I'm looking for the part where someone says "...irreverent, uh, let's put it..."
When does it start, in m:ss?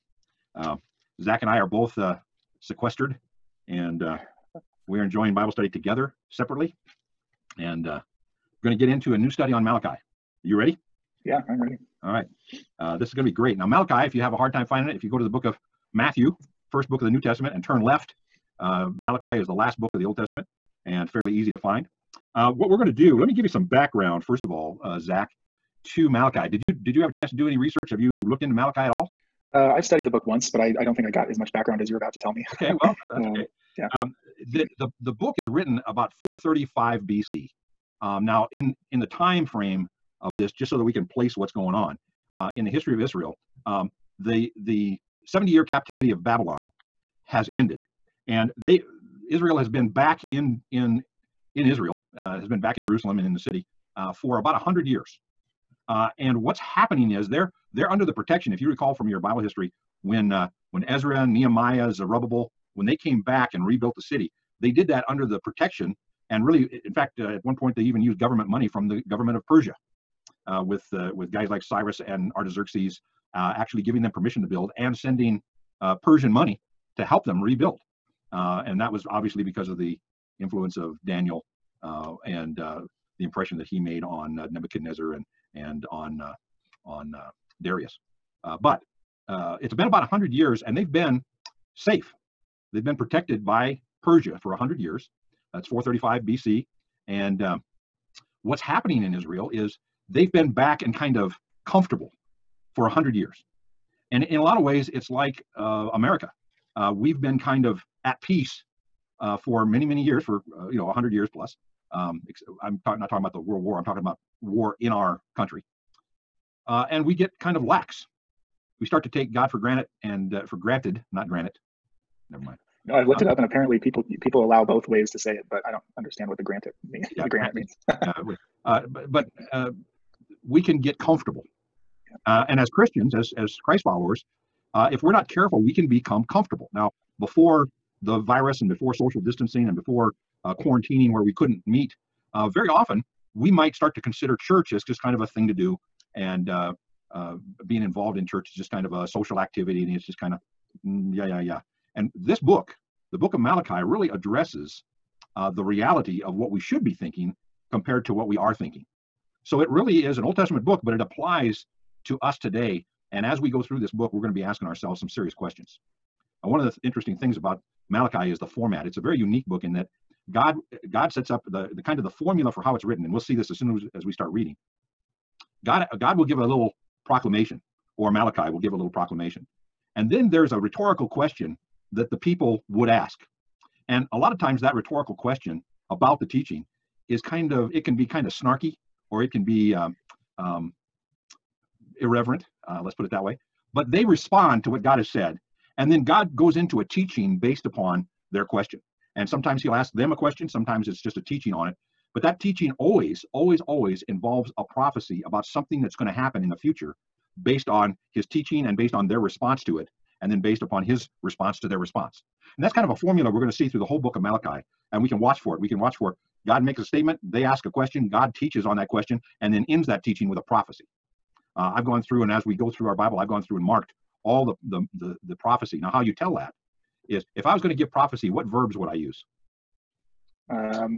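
3:11.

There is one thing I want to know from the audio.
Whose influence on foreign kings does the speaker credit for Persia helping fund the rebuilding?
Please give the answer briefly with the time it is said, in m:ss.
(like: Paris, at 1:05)
Daniel, at 1:21.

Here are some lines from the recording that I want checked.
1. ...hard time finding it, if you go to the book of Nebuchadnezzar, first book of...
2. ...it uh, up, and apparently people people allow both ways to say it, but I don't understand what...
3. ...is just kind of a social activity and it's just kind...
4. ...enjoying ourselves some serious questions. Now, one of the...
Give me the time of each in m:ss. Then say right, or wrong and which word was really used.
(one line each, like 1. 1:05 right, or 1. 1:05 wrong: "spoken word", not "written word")
1. 0:14 wrong: "Matthew", not "Nebuchadnezzar"
2. 2:03 right
3. 2:28 right
4. 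2:44 wrong: "asking", not "enjoying".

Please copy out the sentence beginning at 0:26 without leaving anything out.
Did you did you have a chance to do any research?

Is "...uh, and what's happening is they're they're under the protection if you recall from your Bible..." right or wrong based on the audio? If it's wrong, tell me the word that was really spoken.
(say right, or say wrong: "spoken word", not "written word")
right.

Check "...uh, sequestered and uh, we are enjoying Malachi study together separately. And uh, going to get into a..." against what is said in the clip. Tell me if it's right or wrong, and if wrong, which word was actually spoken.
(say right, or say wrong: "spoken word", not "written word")
wrong: "Bible", not "Malachi".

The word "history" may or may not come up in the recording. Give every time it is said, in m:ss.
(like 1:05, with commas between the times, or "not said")
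0:42, 0:59.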